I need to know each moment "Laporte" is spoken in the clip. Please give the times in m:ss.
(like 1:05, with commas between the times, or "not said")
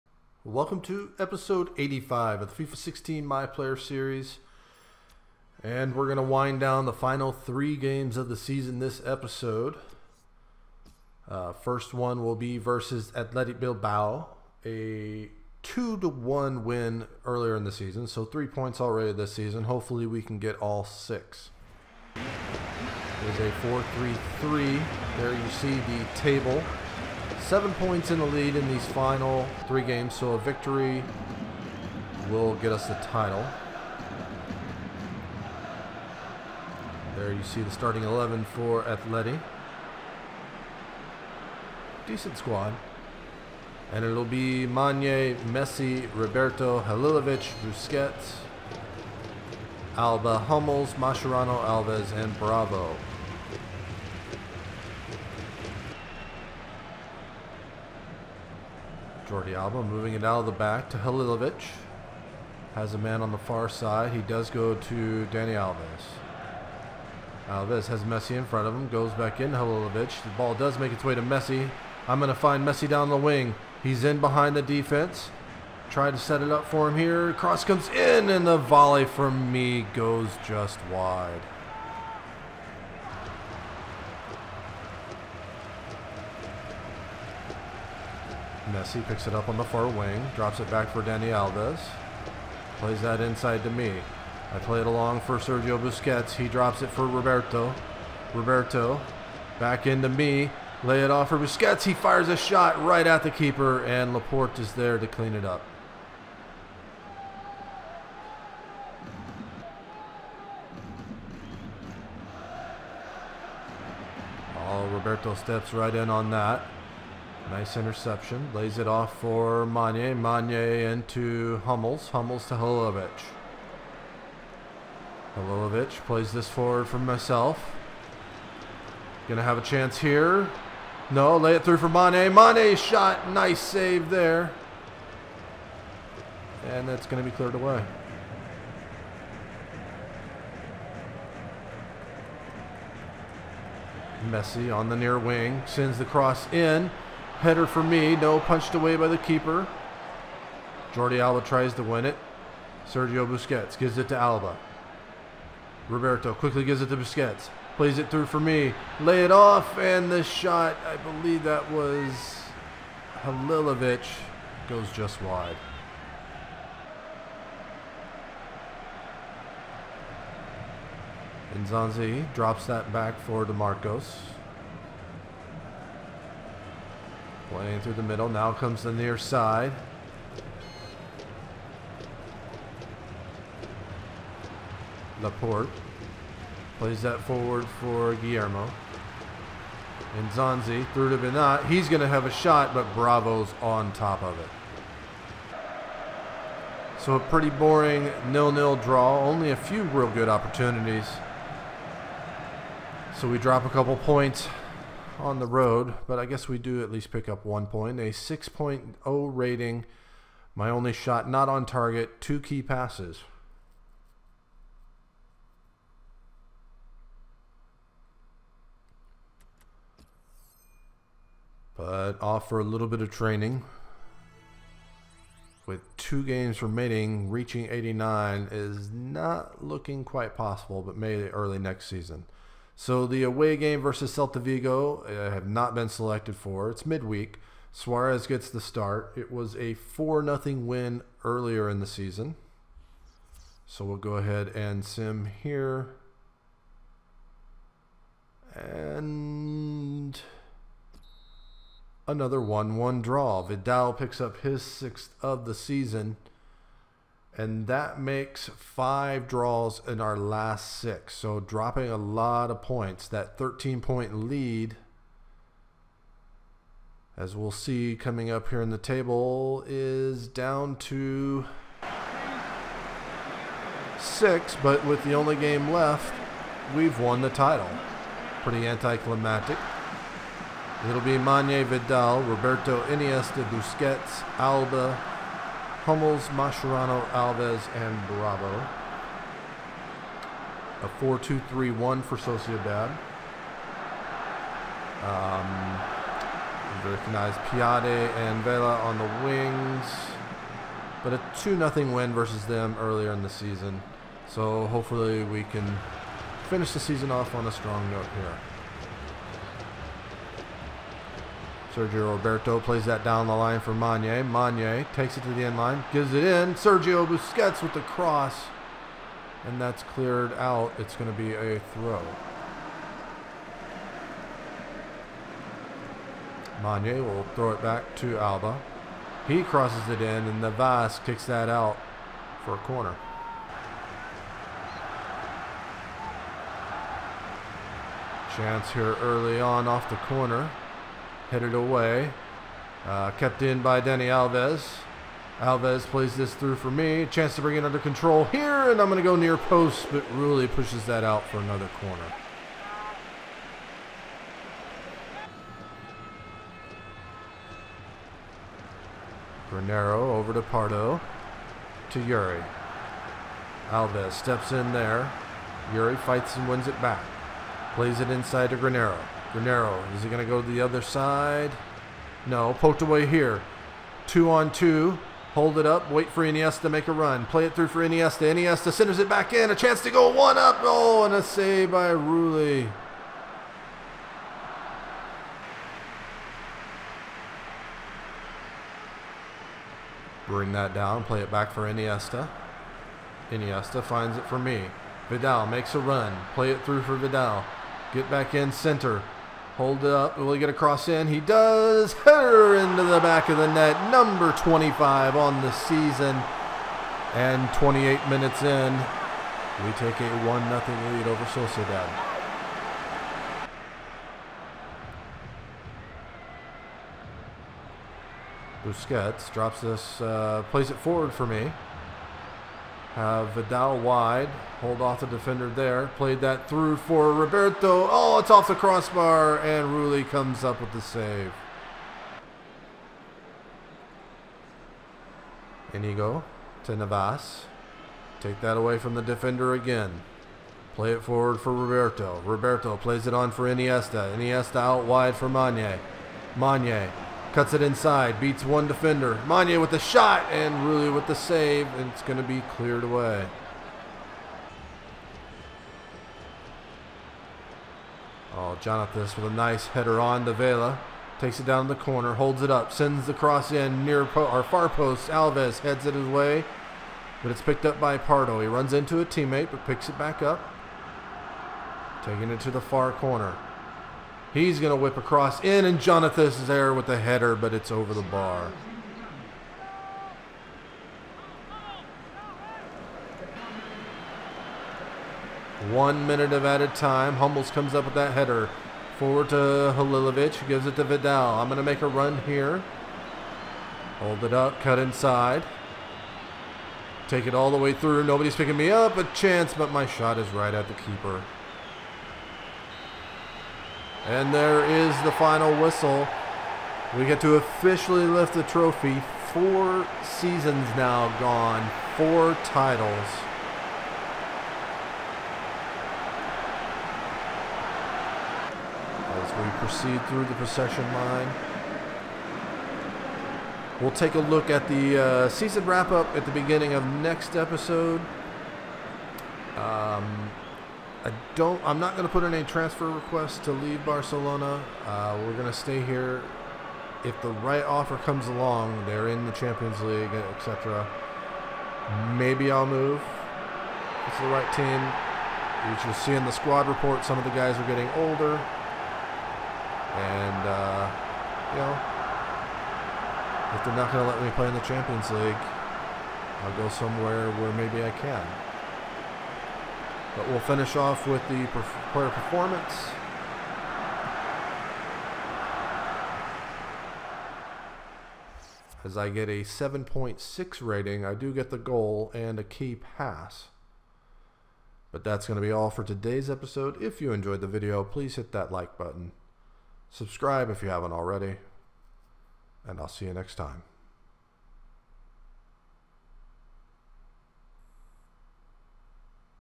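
1:44, 3:05.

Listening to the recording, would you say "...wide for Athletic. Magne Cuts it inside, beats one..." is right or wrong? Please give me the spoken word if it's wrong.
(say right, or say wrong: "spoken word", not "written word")
wrong: "Magne", not "Athletic".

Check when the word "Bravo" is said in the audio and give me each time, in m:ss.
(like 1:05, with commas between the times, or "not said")
0:52, 3:12, 4:48.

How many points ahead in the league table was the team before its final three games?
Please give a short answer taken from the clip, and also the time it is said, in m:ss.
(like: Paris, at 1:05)
7, at 0:27.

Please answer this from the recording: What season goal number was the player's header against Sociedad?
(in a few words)
25.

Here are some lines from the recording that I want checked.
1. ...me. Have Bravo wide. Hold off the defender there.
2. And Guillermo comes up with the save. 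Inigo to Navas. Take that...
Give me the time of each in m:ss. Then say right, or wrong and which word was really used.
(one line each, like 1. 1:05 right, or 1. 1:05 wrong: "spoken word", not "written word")
1. 7:01 wrong: "Vidal", not "Bravo"
2. 7:09 wrong: "Rulli", not "Guillermo".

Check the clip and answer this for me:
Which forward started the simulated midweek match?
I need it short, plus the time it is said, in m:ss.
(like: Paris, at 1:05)
Suarez, at 3:57.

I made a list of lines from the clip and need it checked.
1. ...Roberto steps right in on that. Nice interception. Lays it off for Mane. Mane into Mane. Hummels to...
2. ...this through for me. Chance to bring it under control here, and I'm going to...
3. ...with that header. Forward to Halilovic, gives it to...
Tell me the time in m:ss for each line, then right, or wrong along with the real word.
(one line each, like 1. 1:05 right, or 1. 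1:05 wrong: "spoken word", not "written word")
1. 1:54 wrong: "Hummels", not "Mane"
2. 5:46 right
3. 8:07 right.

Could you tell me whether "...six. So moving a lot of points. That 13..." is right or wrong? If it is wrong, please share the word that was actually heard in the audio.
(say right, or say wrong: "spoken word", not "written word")
wrong: "dropping", not "moving".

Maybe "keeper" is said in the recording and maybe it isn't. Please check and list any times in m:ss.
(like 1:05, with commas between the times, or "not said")
1:43, 2:29, 8:20.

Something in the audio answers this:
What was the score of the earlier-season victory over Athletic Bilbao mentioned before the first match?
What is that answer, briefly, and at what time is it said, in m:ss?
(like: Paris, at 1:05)
2-1, at 0:15.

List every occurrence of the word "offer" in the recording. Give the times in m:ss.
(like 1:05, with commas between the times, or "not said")
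3:42, 8:57.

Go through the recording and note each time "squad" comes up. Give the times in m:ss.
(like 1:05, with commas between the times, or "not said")
0:42, 9:06.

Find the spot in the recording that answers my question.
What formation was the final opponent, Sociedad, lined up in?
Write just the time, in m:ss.
4:51.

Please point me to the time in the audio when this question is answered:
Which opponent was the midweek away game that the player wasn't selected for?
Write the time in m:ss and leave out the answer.
3:54.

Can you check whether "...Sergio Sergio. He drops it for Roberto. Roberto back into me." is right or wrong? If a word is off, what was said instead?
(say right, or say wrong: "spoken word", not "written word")
wrong: "Busquets", not "Sergio".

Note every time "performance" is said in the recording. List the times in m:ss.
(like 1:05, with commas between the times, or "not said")
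9:22.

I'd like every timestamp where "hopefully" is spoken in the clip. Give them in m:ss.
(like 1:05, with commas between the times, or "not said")
0:19, 5:04.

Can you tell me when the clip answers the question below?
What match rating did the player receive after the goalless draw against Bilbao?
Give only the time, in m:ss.
3:28.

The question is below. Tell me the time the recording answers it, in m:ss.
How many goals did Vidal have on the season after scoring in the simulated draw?
4:14.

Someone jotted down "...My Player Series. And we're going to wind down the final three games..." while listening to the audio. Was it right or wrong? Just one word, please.
right.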